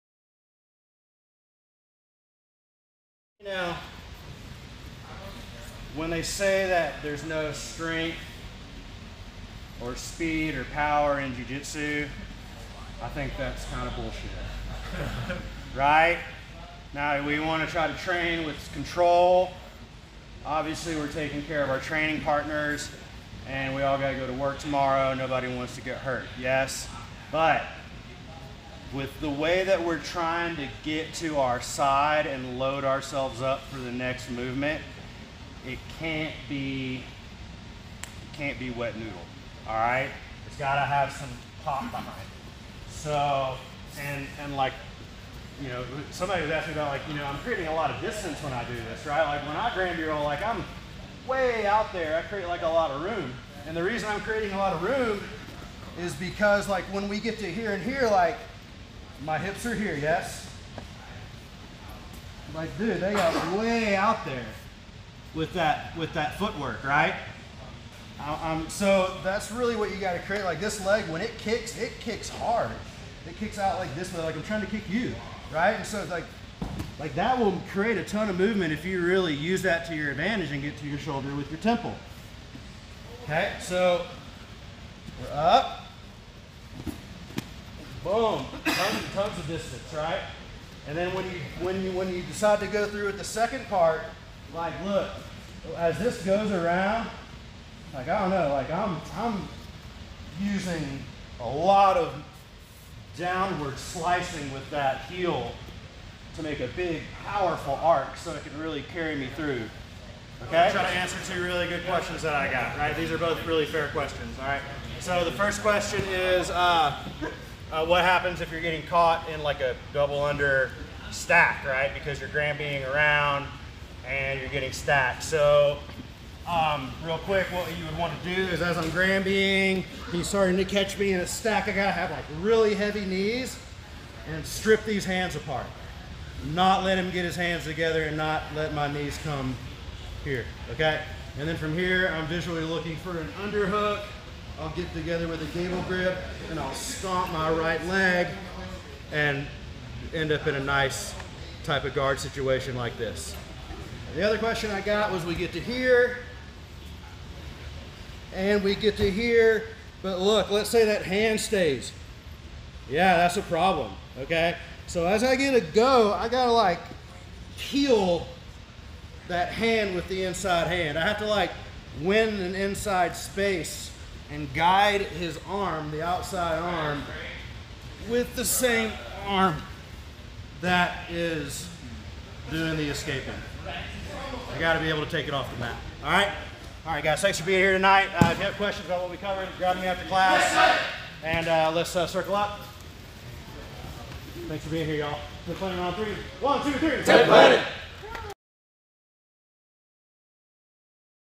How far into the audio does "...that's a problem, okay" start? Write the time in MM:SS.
02:43.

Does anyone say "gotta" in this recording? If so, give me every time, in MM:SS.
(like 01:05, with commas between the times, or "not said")
00:40, 02:11, 02:46.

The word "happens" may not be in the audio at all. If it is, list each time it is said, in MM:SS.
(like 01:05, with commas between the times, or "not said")
01:58.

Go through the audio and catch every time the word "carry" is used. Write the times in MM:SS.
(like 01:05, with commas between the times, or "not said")
01:48.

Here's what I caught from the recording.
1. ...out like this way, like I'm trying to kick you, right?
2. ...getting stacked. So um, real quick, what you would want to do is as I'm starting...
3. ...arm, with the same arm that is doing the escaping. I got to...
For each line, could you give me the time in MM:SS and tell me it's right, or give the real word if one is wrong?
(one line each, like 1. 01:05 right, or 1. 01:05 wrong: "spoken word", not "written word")
1. 01:13 right
2. 02:04 wrong: "granbying", not "starting"
3. 02:56 right.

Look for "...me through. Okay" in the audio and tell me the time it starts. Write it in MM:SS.
01:49.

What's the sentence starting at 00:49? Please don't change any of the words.
Like when I Granby roll, like I'm way out there, I create like a lot of room.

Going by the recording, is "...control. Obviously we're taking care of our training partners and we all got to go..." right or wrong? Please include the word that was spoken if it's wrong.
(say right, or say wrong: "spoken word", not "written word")
right.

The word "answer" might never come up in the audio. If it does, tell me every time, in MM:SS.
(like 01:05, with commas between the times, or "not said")
01:50.